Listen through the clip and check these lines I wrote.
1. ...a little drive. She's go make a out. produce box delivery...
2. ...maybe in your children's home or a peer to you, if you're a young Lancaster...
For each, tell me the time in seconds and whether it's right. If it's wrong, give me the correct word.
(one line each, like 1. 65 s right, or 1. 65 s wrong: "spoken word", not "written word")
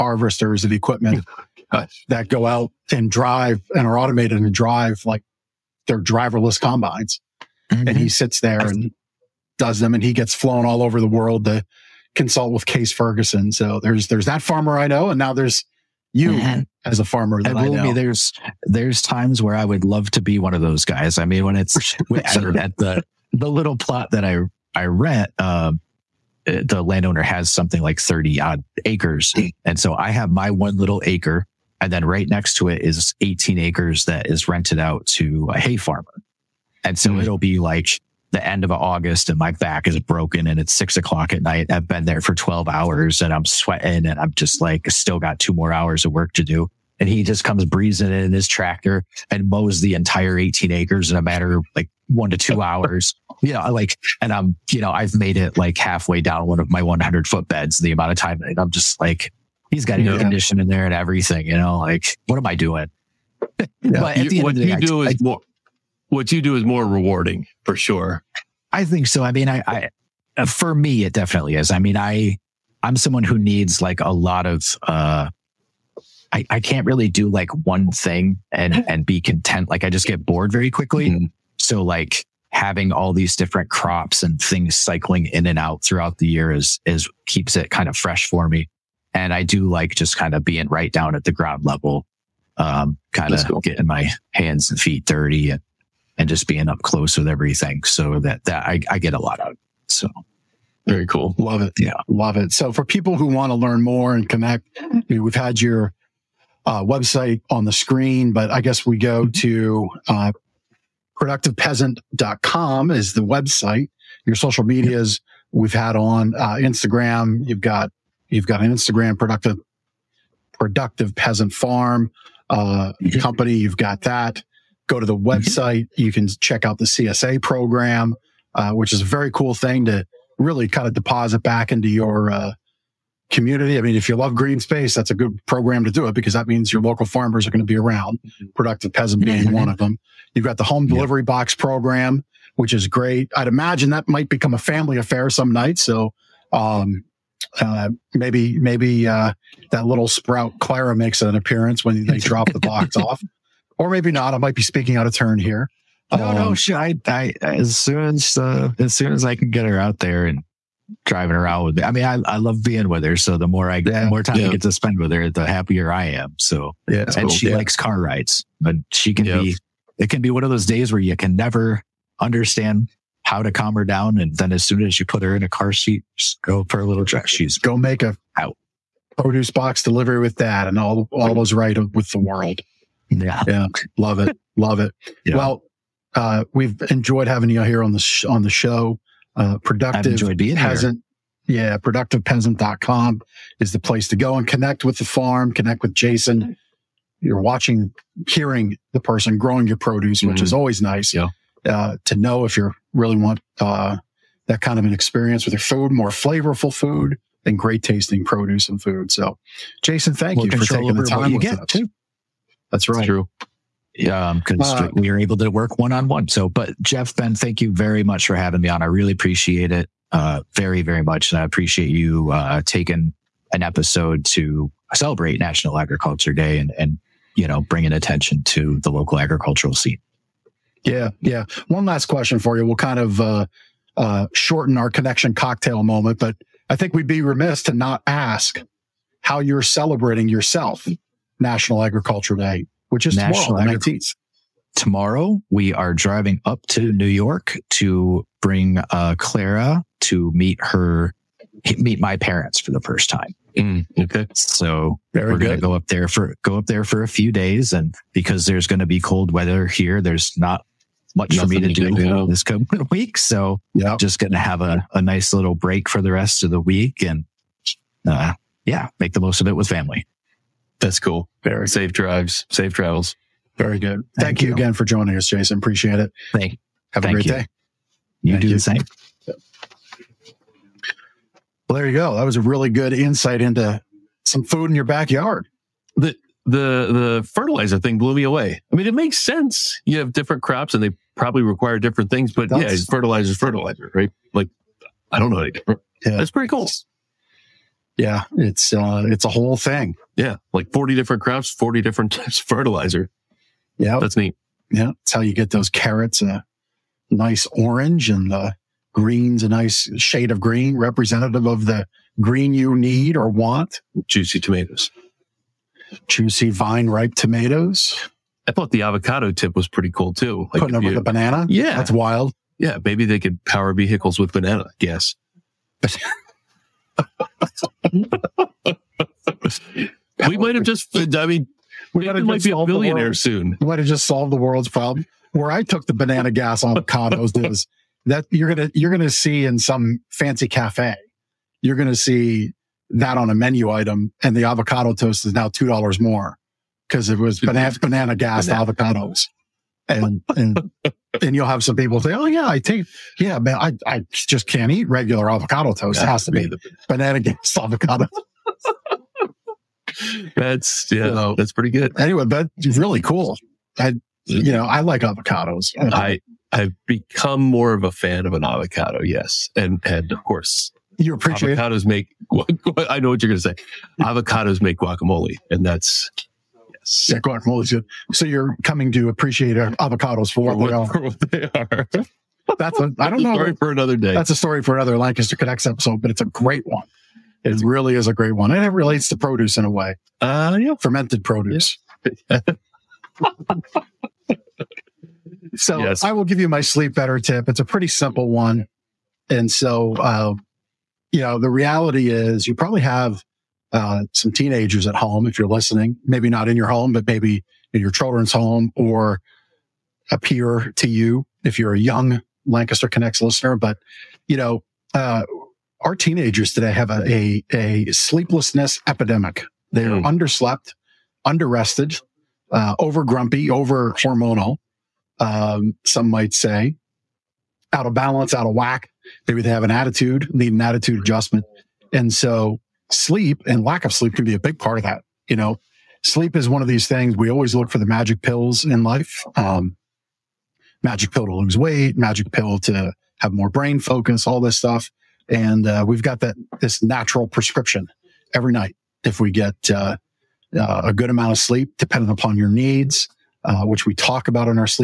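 1. 176 s right
2. 407 s right.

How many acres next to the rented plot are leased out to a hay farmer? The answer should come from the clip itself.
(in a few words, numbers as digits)
18.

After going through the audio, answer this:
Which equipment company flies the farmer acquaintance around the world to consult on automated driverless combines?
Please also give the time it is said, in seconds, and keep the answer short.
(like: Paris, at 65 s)
Case Ferguson, at 12 s.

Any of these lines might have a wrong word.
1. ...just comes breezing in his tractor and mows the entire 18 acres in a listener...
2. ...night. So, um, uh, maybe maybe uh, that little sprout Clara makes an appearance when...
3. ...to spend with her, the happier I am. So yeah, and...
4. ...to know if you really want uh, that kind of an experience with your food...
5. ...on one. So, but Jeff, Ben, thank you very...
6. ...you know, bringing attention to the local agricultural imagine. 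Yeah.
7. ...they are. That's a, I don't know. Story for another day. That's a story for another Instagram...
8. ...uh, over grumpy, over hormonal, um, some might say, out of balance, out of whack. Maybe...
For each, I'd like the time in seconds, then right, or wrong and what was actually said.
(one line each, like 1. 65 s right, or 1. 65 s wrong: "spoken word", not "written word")
1. 47 s wrong: "matter", not "listener"
2. 145 s right
3. 164 s right
4. 202 s right
5. 215 s right
6. 227 s wrong: "scene", not "imagine"
7. 381 s wrong: "Lancaster", not "Instagram"
8. 422 s right.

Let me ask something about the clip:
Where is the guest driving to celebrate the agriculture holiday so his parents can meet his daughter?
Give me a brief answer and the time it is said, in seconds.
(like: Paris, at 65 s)
New York, at 246 s.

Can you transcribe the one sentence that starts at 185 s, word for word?
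Well, uh, we've enjoyed having you here on the, sh- on the show.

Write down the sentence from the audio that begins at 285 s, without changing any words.
The the the fertilizer thing blew me away.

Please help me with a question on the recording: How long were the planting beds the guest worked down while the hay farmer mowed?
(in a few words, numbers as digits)
100 foot.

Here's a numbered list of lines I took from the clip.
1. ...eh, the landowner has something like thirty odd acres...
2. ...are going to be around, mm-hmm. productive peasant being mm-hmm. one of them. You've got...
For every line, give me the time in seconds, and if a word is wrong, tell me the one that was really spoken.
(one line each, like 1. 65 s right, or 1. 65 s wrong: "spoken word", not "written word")
1. 26 s right
2. 137 s right.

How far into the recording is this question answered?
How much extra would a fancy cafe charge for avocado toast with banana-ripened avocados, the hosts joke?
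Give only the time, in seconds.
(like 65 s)
345 s.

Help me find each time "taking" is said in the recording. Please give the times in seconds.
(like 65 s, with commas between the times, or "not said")
210 s, 222 s.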